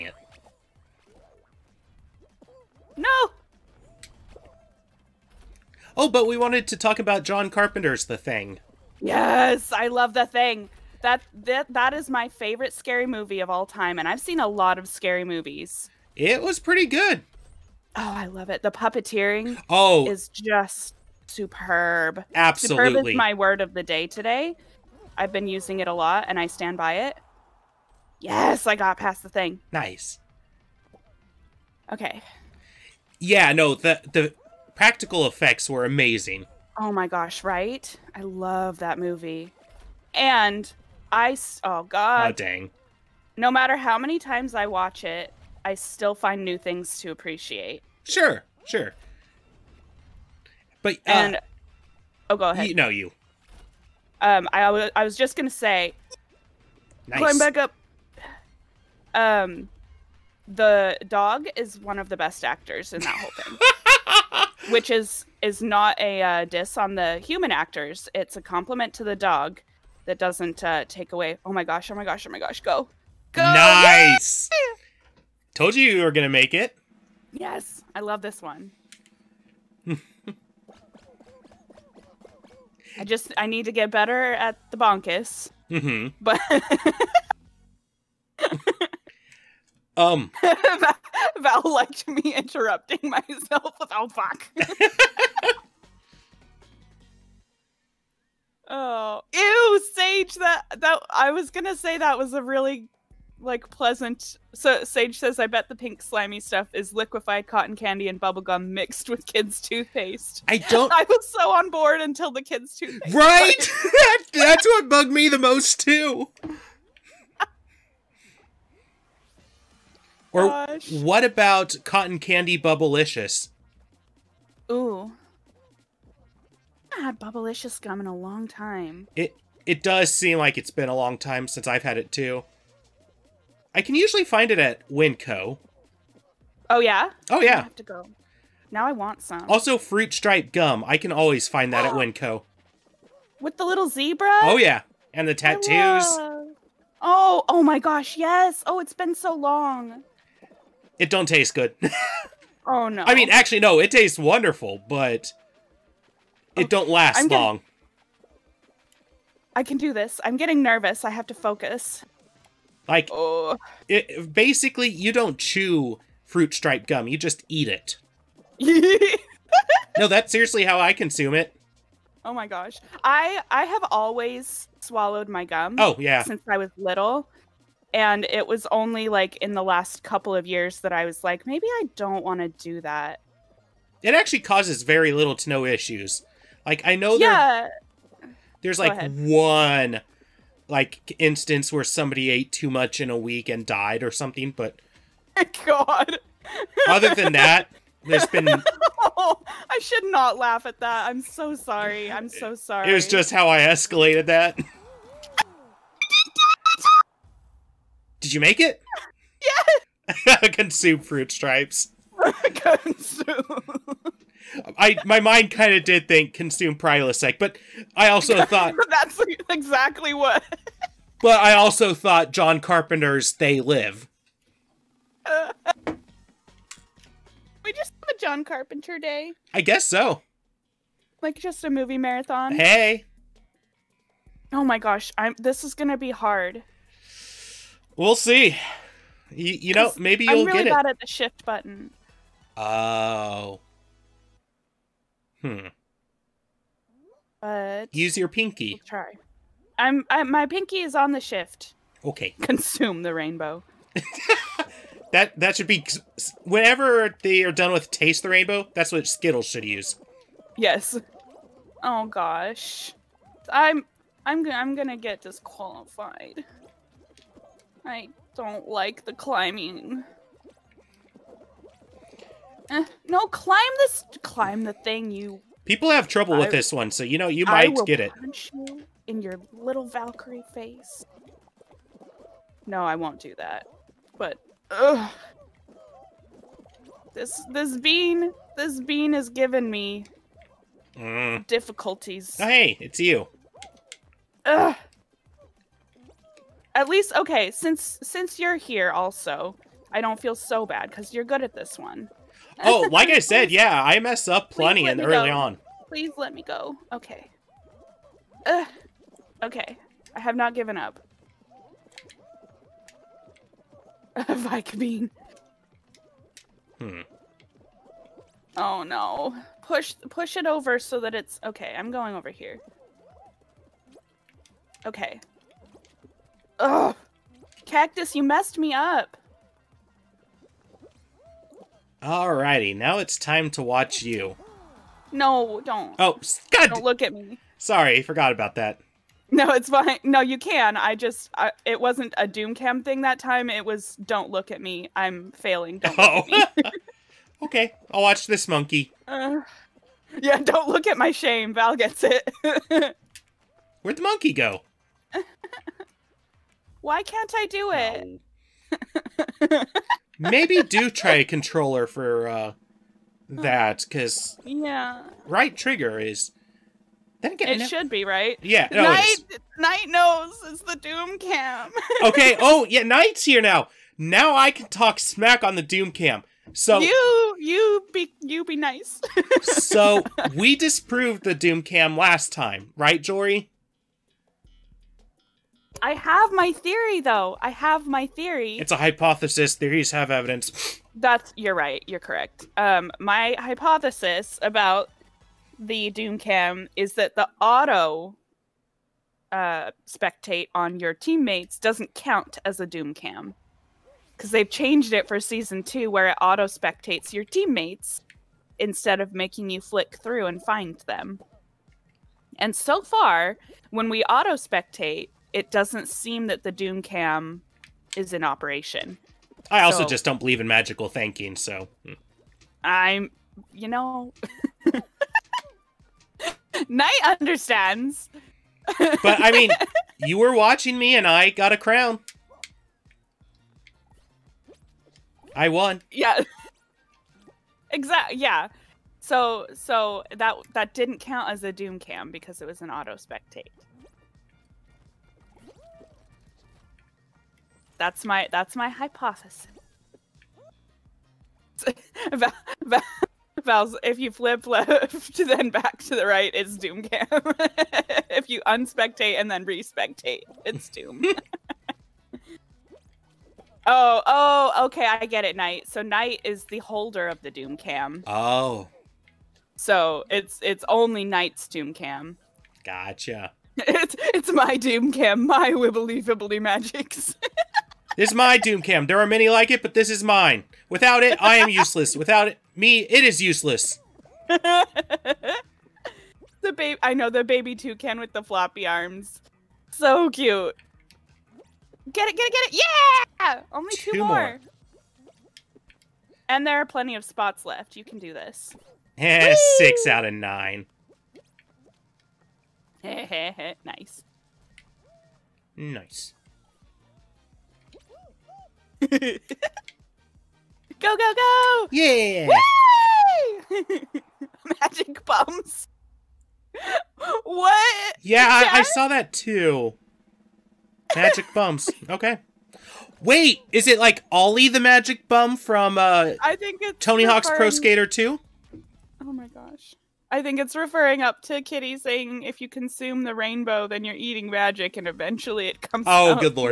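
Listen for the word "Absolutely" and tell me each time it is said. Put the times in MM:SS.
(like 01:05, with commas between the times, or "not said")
00:22.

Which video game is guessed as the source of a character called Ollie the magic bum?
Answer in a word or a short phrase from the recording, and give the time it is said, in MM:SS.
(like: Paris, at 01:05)
Tony Hawk's Pro Skater 2, at 08:46.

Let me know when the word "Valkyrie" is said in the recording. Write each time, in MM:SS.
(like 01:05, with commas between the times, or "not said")
04:39.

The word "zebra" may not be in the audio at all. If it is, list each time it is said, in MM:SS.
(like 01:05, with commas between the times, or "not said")
02:23.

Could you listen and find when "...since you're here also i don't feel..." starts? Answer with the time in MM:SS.
04:58.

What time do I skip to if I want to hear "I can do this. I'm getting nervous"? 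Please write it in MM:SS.
02:39.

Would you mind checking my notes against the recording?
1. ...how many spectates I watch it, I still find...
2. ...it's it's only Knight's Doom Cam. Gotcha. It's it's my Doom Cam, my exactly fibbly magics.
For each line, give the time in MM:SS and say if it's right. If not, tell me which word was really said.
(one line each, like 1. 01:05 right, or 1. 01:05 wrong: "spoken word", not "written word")
1. 00:43 wrong: "times", not "spectates"
2. 07:50 wrong: "wibbly", not "exactly".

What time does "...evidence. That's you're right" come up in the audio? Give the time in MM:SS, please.
06:30.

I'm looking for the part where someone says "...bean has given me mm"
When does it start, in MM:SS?
04:48.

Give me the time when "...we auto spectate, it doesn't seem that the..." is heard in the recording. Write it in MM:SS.
06:53.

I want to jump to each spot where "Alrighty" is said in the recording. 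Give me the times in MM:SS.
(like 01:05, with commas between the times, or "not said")
05:32.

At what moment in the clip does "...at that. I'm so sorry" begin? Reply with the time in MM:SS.
03:20.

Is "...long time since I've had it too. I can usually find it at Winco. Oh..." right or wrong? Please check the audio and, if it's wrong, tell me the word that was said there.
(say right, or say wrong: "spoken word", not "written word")
right.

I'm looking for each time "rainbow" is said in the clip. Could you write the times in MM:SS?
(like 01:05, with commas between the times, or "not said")
04:13, 04:18, 08:53.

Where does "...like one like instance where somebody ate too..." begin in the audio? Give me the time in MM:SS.
03:08.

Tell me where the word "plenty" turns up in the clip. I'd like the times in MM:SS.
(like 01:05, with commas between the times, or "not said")
05:04, 08:16.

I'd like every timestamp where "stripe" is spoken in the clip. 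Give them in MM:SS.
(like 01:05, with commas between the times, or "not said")
02:20, 02:46, 03:31.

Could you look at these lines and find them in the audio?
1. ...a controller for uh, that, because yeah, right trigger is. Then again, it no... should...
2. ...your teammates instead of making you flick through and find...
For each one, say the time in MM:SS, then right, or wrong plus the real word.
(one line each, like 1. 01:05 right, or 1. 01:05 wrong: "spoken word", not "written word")
1. 06:01 right
2. 06:47 right.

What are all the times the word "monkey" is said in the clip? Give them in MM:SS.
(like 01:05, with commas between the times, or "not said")
05:48, 05:54.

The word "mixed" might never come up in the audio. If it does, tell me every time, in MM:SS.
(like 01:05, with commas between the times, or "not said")
01:48.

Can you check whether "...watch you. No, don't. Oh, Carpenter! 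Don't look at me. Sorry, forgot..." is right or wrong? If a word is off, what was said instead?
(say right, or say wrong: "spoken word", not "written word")
wrong: "God", not "Carpenter".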